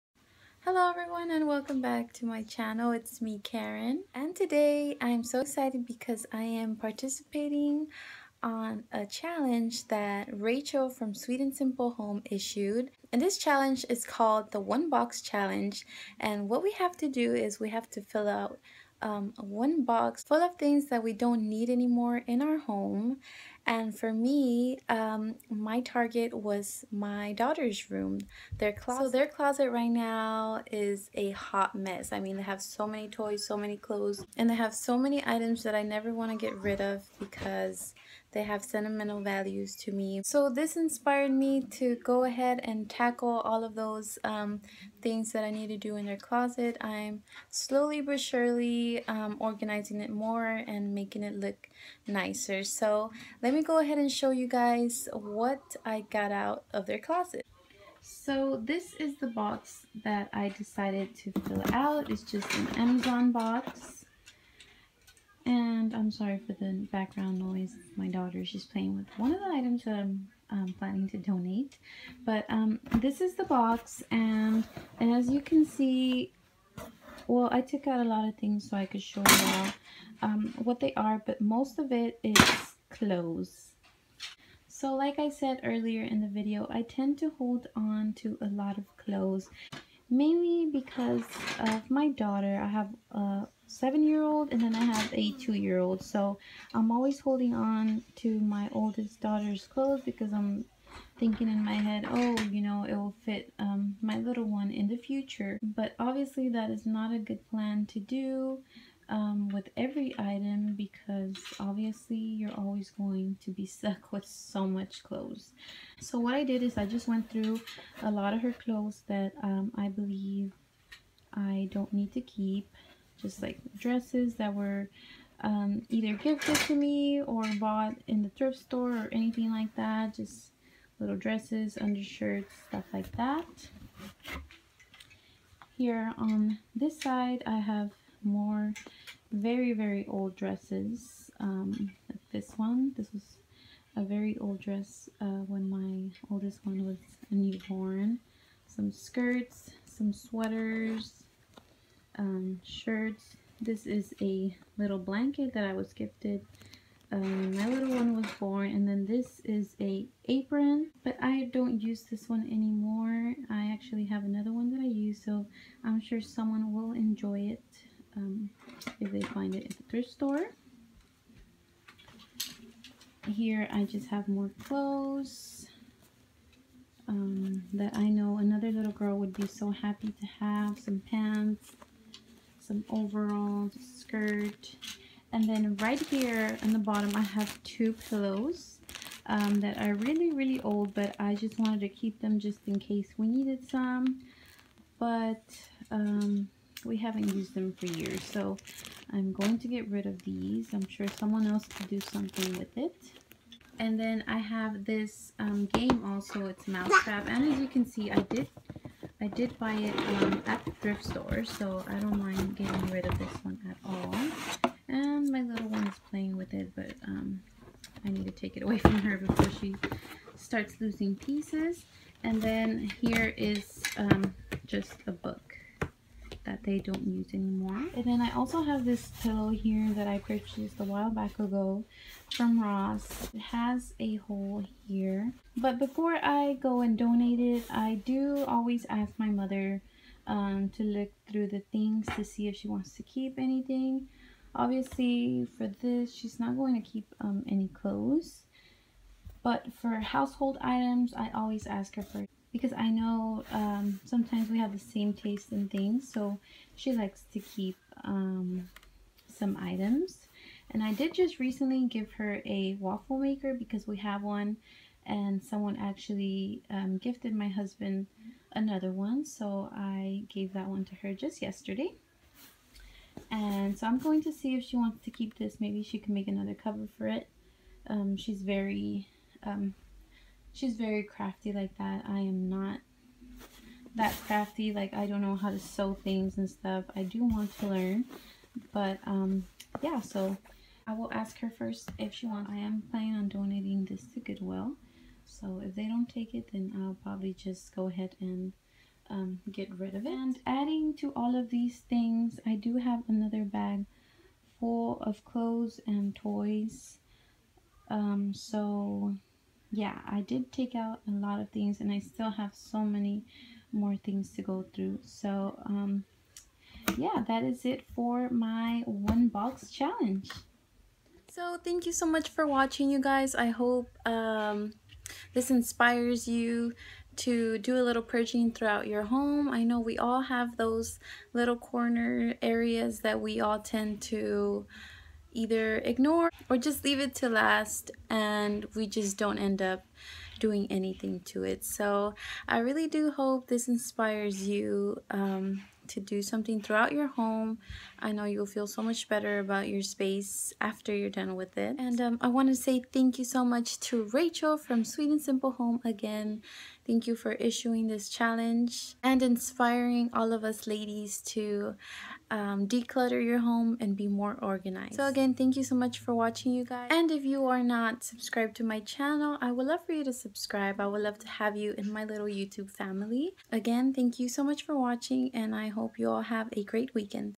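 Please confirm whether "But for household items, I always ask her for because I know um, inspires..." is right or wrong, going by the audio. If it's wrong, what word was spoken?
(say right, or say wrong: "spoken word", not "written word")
wrong: "sometimes", not "inspires".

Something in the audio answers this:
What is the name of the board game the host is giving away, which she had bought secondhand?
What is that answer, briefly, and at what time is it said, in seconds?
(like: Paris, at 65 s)
Mousetrap, at 206 s.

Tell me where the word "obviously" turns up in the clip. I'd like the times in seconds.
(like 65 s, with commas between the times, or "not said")
105 s, 111 s, 244 s.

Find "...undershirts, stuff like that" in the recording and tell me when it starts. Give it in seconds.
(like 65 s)
131 s.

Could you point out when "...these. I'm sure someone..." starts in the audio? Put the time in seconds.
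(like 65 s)
200 s.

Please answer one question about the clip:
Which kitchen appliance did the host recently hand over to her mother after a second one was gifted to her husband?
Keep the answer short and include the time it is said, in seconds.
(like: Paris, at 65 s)
Waffle maker, at 262 s.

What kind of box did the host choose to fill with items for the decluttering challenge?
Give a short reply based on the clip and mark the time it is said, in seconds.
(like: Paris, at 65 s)
Amazon box, at 62 s.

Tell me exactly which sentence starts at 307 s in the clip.
Um, so yeah, I did take out a lot of things and I still have so many more things to go through.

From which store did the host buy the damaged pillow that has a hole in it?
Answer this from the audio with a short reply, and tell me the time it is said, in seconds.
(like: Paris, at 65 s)
Ross, at 232 s.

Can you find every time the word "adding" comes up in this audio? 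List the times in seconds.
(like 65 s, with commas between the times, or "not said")
300 s.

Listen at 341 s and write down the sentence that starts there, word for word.
So I really do hope this inspires you um, to do something throughout your home.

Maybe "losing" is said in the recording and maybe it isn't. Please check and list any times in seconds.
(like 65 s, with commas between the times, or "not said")
220 s.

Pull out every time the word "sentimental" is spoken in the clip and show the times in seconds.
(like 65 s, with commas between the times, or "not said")
38 s.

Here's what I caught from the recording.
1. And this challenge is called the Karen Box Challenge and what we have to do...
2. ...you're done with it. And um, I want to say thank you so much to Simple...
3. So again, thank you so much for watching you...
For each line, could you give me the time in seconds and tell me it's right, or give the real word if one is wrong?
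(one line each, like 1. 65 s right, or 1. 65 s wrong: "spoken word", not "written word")
1. 13 s wrong: "One", not "Karen"
2. 350 s wrong: "Rachel", not "Simple"
3. 364 s right.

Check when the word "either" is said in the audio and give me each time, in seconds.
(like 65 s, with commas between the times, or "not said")
125 s, 335 s.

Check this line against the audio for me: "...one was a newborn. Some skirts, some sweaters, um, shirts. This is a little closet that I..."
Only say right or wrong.
wrong.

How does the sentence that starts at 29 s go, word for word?
So their closet right now is a hot mess.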